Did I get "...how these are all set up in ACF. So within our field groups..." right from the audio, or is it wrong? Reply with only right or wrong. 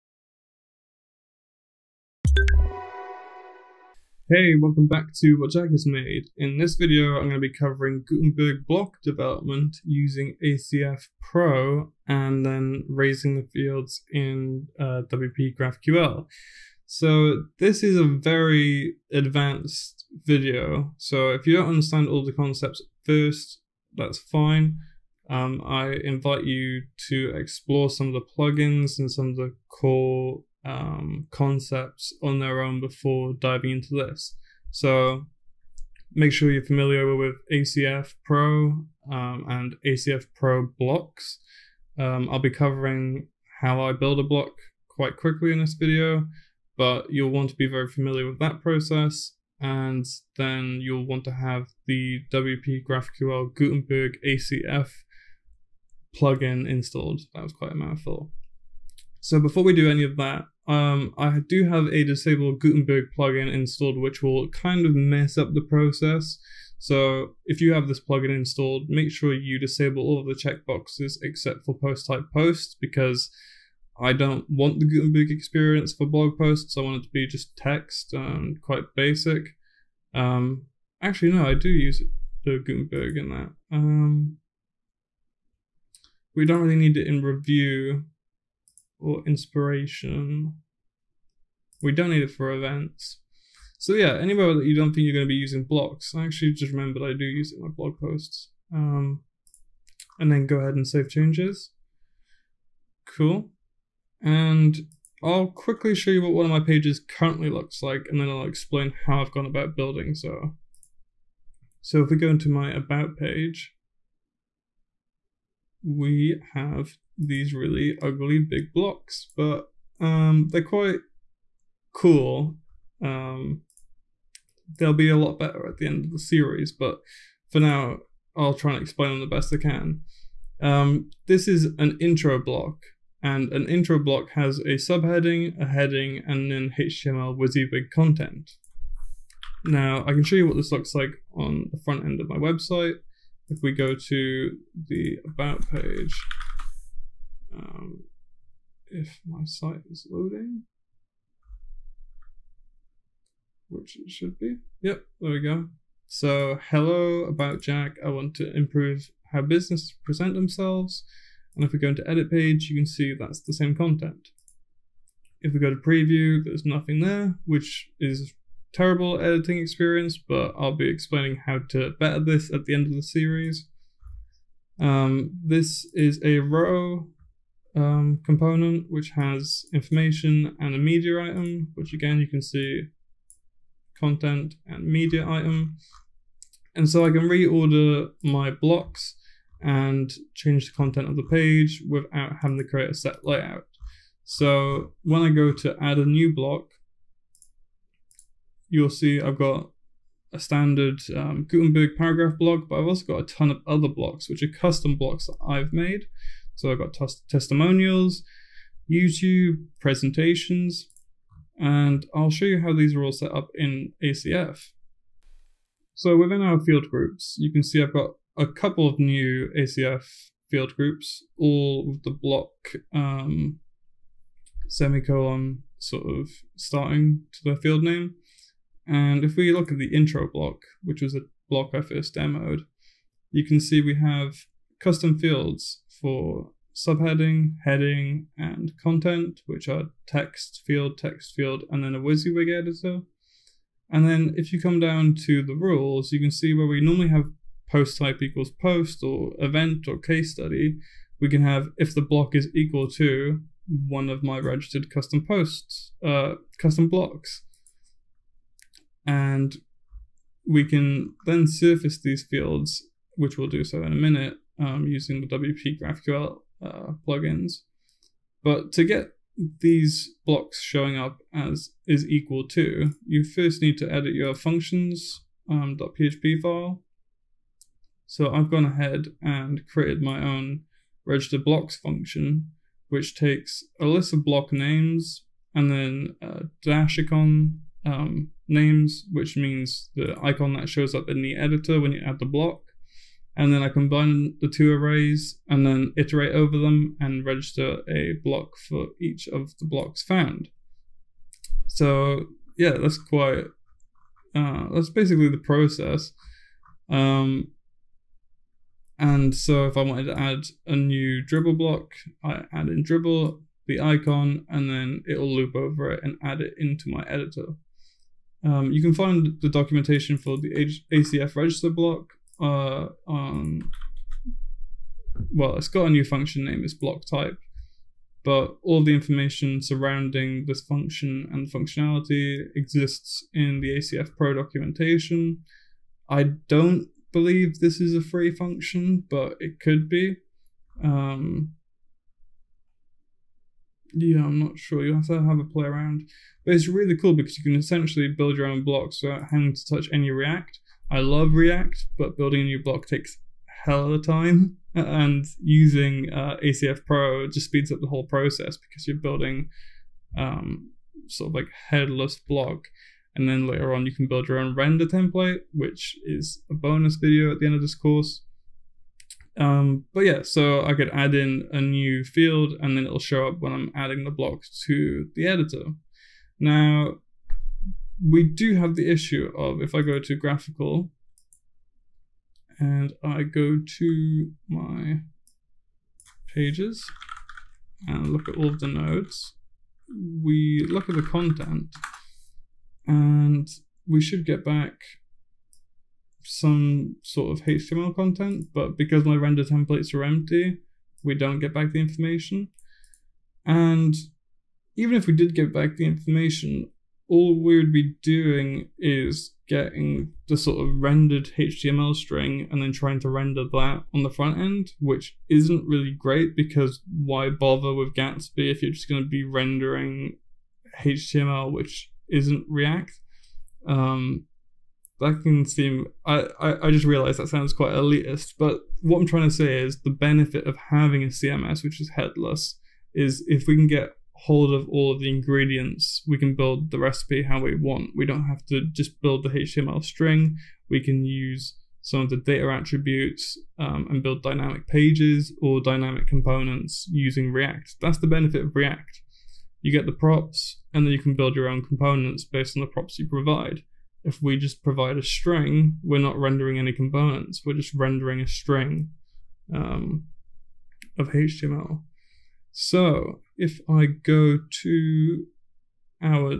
right.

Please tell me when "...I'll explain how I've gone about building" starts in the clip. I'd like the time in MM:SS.
01:48.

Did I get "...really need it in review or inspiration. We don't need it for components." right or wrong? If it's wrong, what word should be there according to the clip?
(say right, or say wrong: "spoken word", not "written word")
wrong: "events", not "components".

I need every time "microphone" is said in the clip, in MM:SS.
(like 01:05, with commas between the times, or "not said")
not said.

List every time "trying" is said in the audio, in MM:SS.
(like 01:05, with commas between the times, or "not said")
06:52, 07:09.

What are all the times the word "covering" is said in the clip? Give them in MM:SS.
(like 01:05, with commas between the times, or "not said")
00:07, 00:42.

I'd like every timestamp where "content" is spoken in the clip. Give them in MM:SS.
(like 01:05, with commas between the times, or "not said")
02:17, 02:43, 03:03, 03:10, 03:58, 06:31, 06:37.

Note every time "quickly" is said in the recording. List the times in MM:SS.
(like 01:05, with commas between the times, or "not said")
00:45, 01:45.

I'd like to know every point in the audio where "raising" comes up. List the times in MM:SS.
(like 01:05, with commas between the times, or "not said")
00:12.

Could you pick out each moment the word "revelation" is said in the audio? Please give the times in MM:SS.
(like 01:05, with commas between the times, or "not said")
not said.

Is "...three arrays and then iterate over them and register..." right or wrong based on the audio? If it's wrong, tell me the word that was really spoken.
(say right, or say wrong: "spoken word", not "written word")
wrong: "two", not "three".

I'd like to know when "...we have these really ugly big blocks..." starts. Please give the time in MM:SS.
01:55.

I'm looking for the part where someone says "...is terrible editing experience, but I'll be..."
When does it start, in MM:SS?
02:47.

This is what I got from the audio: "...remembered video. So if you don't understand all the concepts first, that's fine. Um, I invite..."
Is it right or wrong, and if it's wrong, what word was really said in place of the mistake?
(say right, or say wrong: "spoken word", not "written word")
wrong: "advanced", not "remembered".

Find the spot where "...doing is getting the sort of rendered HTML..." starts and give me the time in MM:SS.
06:48.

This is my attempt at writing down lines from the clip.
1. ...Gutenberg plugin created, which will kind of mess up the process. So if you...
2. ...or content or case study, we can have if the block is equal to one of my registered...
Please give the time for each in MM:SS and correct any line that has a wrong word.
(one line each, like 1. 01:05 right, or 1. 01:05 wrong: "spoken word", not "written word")
1. 01:02 wrong: "installed", not "created"
2. 04:09 wrong: "event", not "content".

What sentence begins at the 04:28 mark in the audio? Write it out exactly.
But to get these blocks showing up as is equal to, you first need to edit your functions um, .php file.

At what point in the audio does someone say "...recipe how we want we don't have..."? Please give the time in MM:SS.
07:16.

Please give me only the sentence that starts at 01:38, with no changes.
Um, and then go ahead and save changes.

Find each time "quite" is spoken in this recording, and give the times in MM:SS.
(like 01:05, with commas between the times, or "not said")
00:44, 00:57, 01:18, 02:00, 05:02, 07:07.